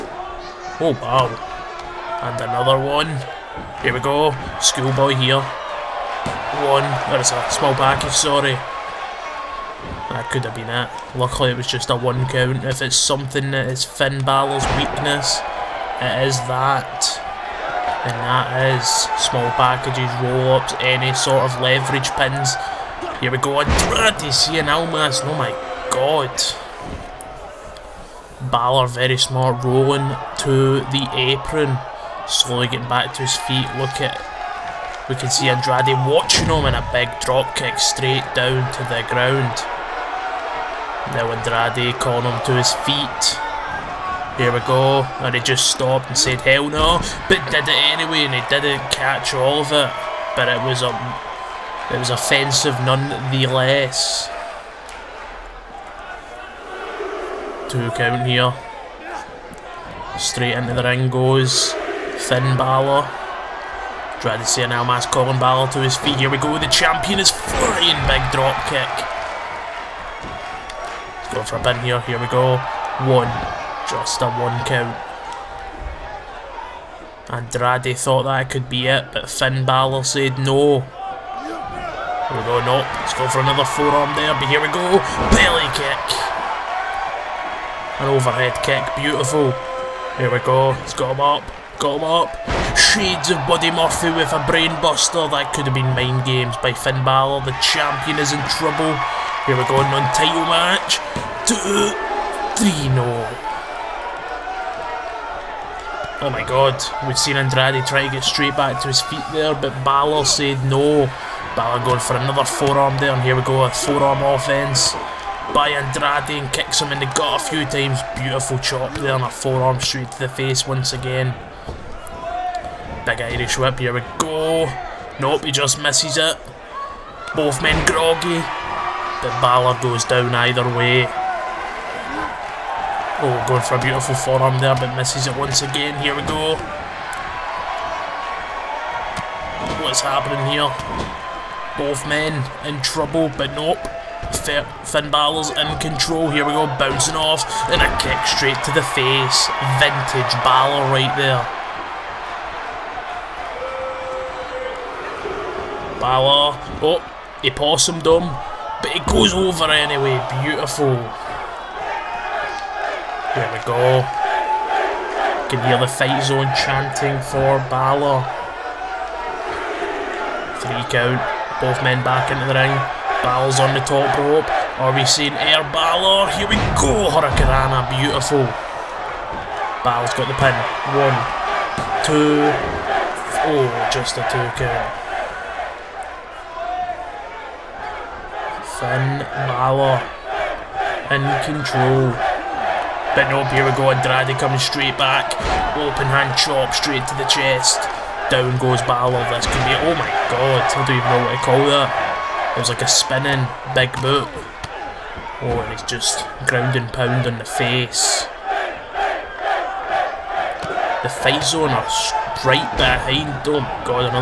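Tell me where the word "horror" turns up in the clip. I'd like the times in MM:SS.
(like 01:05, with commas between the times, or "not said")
not said.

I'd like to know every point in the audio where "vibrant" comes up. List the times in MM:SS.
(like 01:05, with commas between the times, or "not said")
not said.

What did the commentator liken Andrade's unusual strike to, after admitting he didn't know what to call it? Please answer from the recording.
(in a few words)
A spinning big boot.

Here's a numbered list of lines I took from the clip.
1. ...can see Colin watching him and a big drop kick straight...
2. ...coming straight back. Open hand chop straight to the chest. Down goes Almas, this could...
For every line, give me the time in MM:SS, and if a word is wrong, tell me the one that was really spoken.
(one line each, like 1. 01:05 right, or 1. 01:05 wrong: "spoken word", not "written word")
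1. 00:35 wrong: "Andrade", not "Colin"
2. 03:14 wrong: "Balor", not "Almas".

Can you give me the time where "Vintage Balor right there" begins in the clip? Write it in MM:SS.
02:29.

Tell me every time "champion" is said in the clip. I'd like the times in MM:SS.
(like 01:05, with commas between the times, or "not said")
01:06, 01:37.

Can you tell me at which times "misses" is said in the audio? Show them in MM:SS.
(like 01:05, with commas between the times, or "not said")
02:05, 02:14.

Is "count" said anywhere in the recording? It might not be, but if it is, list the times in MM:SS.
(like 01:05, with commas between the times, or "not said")
00:12, 00:57, 01:14, 02:50, 03:04.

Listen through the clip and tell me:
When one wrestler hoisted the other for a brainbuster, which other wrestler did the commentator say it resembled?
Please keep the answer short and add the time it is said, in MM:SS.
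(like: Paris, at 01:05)
Buddy Murphy, at 01:33.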